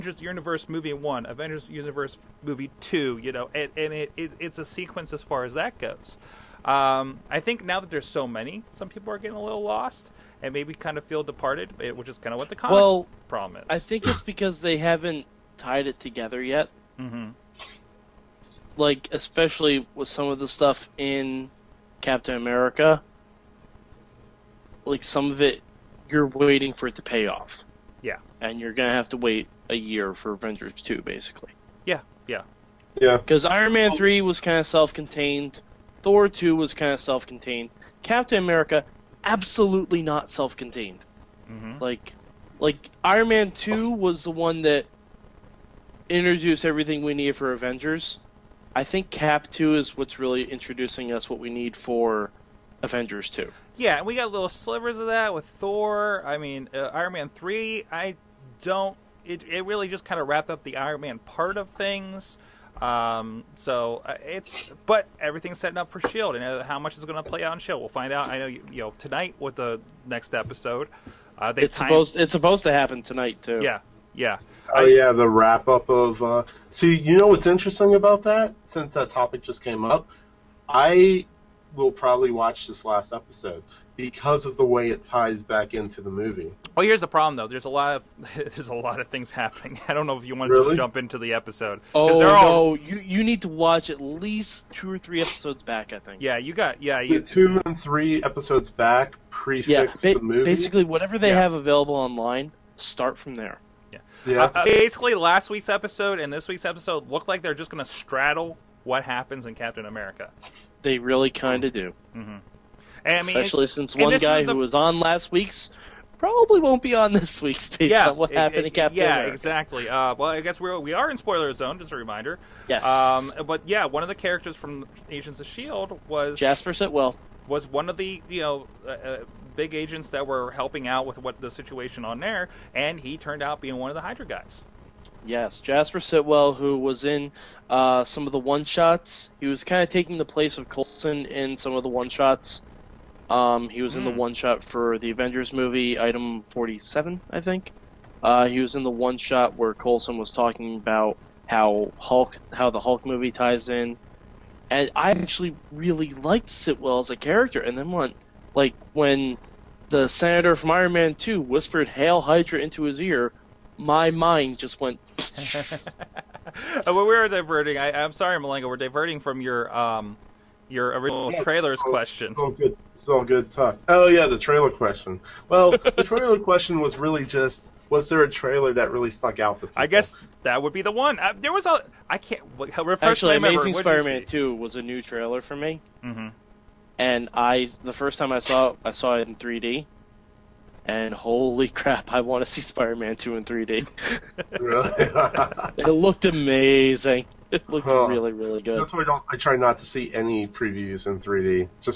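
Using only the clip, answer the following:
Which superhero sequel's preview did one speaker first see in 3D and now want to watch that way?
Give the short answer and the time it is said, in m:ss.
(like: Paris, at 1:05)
Amazing Spider-Man 2, at 3:03.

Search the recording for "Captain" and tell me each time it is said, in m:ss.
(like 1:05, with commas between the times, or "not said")
0:22, 0:38, 1:49, 1:58.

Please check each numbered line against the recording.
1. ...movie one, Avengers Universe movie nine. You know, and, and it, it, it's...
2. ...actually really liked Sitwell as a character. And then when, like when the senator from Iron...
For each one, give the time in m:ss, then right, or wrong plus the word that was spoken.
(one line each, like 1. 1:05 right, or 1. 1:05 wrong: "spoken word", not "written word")
1. 0:00 wrong: "two", not "nine"
2. 2:35 right.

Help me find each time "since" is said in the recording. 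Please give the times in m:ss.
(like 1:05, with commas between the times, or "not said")
1:18, 1:53.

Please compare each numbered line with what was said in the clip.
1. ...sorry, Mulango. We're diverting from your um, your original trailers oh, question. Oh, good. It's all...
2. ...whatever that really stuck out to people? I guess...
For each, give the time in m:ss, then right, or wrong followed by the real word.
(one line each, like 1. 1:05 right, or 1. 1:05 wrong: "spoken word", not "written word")
1. 2:48 right
2. 2:58 wrong: "trailer", not "whatever".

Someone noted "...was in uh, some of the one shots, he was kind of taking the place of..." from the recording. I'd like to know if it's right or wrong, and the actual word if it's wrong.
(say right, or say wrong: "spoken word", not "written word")
right.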